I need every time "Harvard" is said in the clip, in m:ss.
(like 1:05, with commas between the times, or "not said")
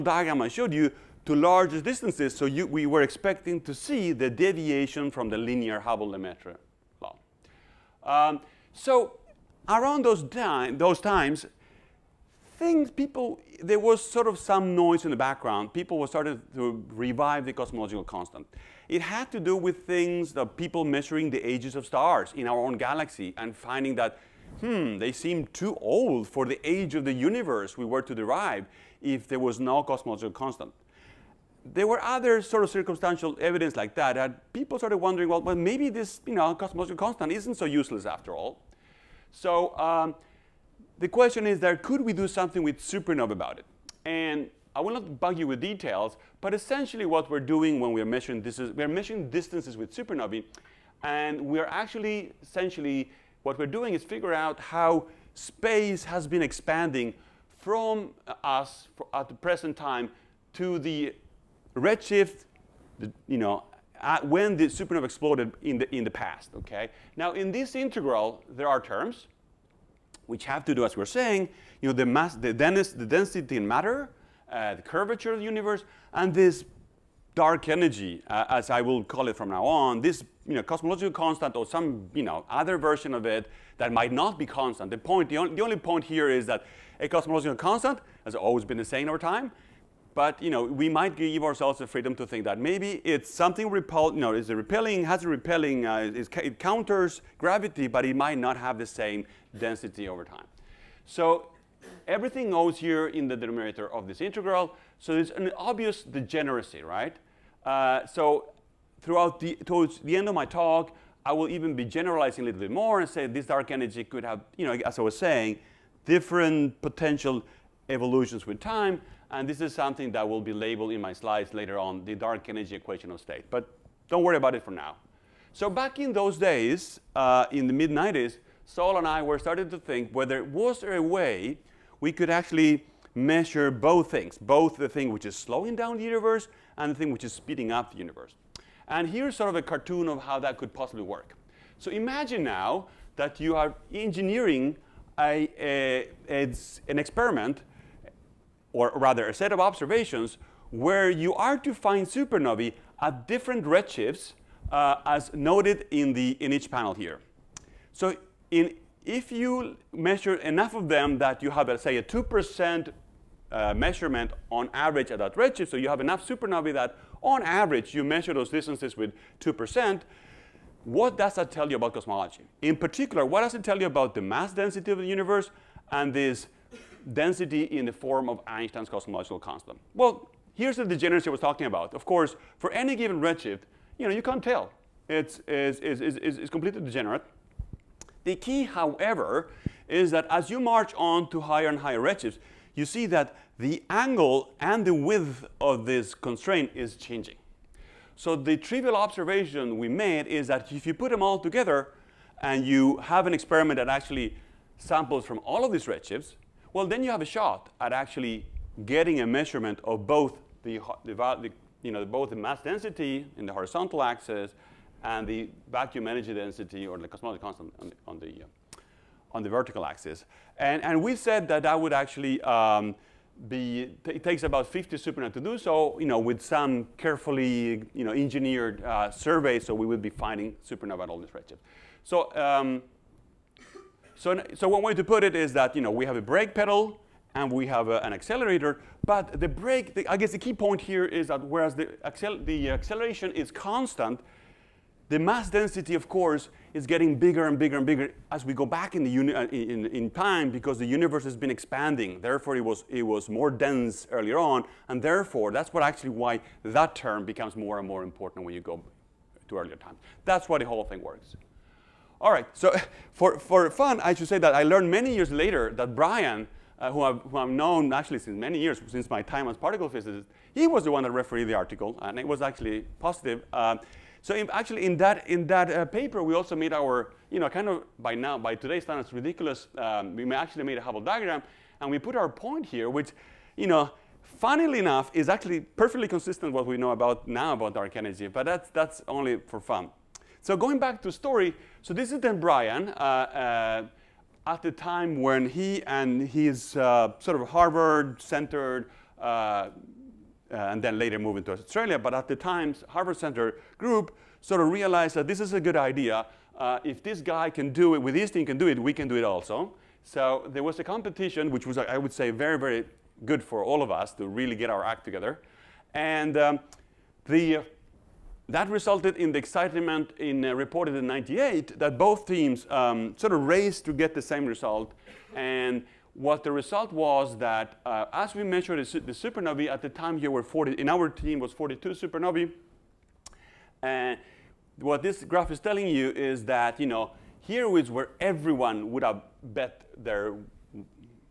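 4:57, 5:02.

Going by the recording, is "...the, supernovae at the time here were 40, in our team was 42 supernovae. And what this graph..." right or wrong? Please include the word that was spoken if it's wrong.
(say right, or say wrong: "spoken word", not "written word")
right.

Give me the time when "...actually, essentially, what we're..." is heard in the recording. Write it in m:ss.
0:51.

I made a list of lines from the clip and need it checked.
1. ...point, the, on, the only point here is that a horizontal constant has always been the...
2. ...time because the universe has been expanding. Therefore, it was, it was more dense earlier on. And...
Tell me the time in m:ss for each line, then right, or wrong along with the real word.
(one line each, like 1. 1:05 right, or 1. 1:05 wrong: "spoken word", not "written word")
1. 1:24 wrong: "cosmological", not "horizontal"
2. 4:10 right.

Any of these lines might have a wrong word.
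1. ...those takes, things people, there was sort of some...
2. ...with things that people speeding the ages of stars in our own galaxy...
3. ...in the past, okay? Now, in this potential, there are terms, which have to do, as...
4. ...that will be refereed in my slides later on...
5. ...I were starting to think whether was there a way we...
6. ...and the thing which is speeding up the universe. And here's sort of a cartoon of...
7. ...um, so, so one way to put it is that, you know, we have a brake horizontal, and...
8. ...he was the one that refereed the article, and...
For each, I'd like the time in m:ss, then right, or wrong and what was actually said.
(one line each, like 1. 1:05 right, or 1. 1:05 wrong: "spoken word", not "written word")
1. 0:10 wrong: "times", not "takes"
2. 0:19 wrong: "measuring", not "speeding"
3. 1:05 wrong: "integral", not "potential"
4. 2:00 wrong: "labeled", not "refereed"
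5. 2:09 right
6. 2:16 right
7. 3:52 wrong: "pedal", not "horizontal"
8. 4:30 right.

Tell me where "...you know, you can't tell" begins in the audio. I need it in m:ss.
3:03.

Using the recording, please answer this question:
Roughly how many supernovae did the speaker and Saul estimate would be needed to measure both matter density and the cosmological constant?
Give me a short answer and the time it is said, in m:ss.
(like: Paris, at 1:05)
50, at 3:44.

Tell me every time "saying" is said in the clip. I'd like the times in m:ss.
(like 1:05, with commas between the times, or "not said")
1:11, 1:55.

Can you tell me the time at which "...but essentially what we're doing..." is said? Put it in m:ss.
0:46.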